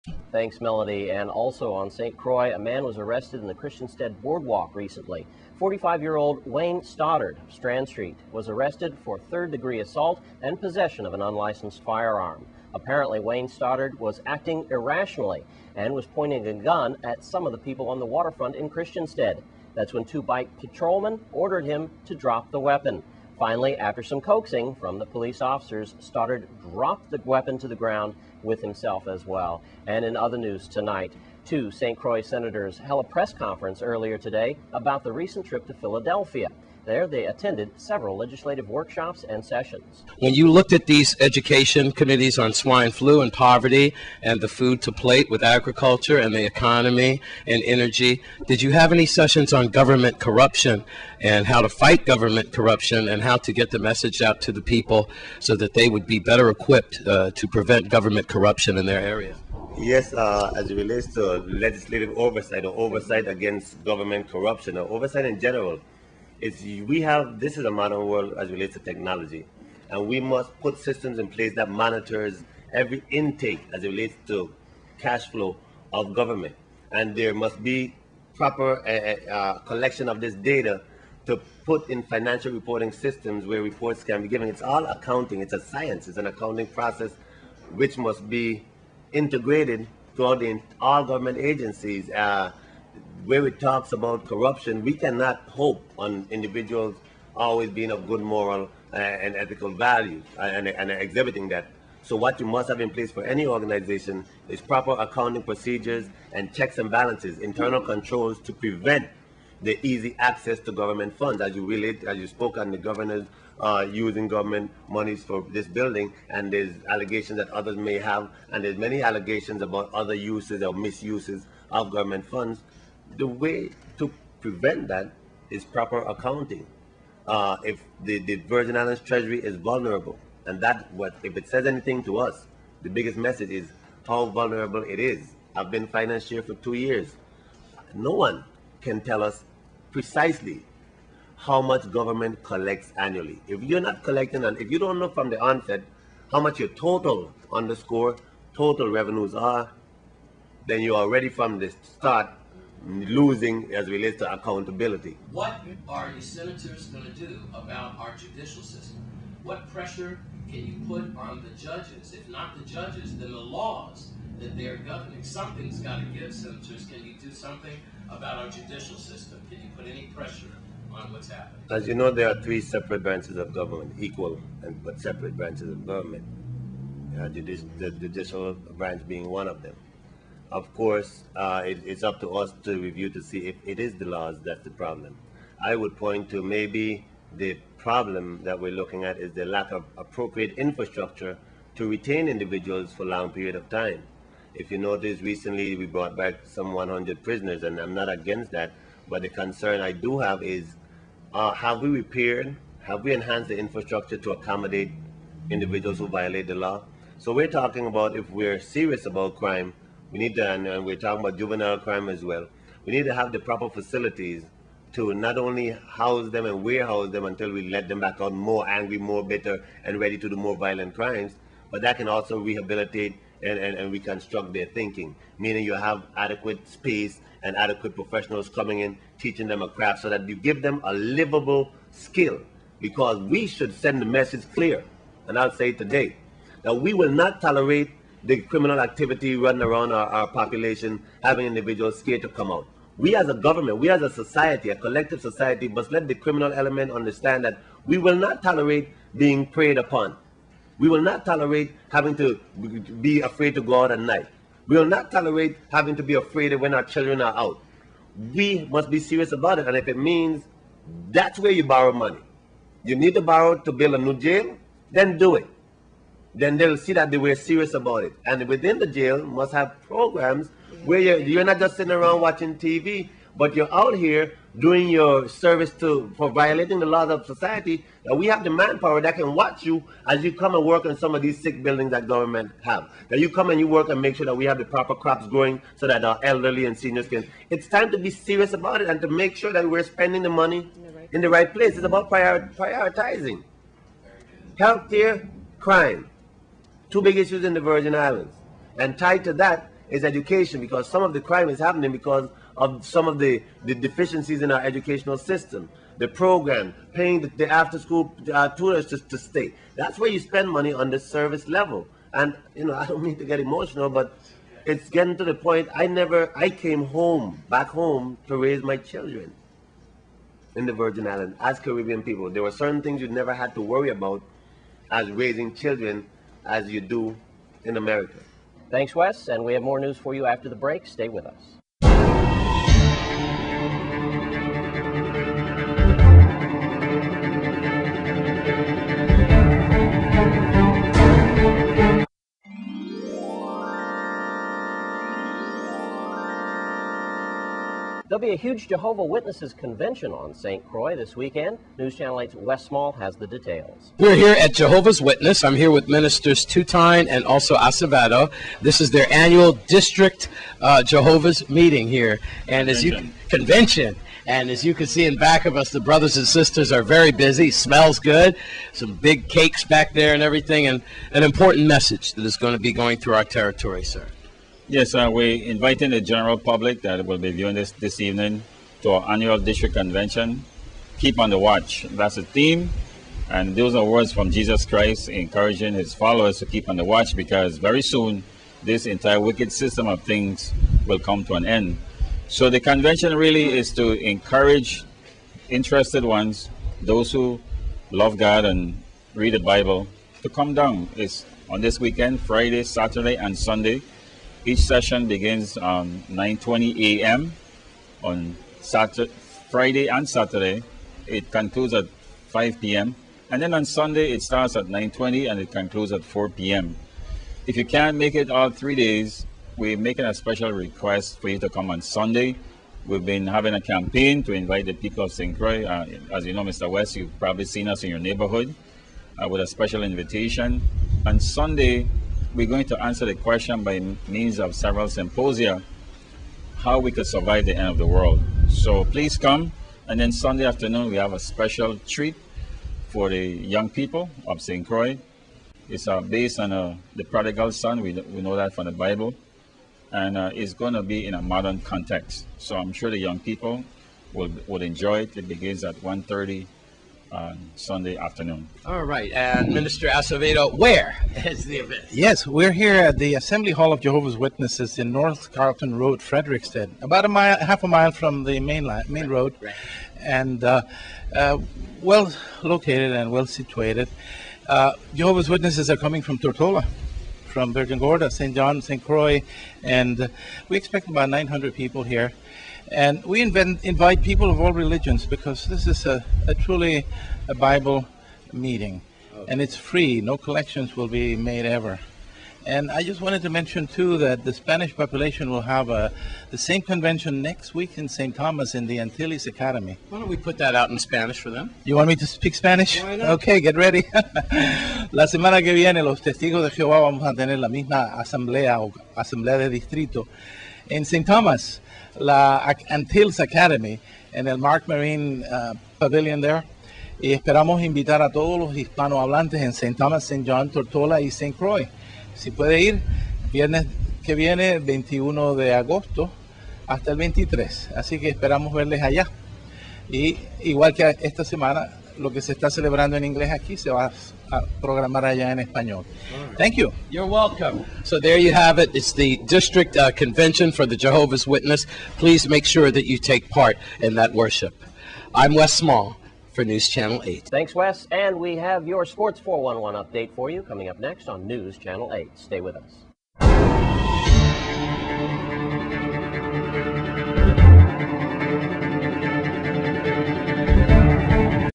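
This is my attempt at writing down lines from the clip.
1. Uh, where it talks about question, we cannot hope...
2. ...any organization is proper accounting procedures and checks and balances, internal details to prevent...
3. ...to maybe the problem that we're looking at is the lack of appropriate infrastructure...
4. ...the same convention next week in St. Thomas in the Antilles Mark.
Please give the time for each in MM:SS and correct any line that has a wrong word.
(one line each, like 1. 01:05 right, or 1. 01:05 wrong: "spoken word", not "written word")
1. 01:32 wrong: "corruption", not "question"
2. 01:43 wrong: "controls", not "details"
3. 03:06 right
4. 08:16 wrong: "Academy", not "Mark".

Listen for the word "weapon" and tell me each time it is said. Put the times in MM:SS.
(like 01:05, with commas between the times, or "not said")
00:22, 00:27.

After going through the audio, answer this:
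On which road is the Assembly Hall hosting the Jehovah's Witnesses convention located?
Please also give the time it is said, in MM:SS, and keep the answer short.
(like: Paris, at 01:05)
North Carlton Road, at 07:44.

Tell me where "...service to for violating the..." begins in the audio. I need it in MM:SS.
04:35.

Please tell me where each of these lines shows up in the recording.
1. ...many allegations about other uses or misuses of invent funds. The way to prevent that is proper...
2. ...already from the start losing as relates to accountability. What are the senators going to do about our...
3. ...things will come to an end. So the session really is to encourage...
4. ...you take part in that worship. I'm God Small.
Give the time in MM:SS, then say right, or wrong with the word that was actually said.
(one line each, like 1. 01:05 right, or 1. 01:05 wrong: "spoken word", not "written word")
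1. 01:58 wrong: "government", not "invent"
2. 02:30 right
3. 06:30 wrong: "convention", not "session"
4. 09:02 wrong: "Wes", not "God".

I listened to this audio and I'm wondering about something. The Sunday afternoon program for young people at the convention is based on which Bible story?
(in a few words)
The prodigal son.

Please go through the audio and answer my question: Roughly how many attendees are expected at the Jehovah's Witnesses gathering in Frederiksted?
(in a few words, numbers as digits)
900.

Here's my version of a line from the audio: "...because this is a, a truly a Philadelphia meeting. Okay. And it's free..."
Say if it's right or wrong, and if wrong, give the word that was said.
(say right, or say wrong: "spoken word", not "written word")
wrong: "Bible", not "Philadelphia".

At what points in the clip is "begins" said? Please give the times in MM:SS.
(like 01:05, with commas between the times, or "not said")
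06:45, 07:35.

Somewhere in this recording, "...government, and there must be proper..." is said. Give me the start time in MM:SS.
01:16.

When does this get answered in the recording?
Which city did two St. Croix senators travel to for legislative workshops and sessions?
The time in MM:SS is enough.
00:35.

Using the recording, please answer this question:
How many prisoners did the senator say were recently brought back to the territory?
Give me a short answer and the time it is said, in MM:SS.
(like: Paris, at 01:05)
100, at 03:16.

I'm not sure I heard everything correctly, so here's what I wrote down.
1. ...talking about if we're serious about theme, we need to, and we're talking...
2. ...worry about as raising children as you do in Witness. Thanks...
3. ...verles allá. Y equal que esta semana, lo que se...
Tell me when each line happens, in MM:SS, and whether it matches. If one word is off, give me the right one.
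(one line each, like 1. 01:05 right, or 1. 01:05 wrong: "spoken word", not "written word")
1. 03:27 wrong: "crime", not "theme"
2. 05:23 wrong: "America", not "Witness"
3. 08:48 wrong: "igual", not "equal".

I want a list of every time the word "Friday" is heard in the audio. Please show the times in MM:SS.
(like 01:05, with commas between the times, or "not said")
06:42, 06:49.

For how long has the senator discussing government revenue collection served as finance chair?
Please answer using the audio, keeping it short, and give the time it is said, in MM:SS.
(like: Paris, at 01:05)
2 years, at 02:16.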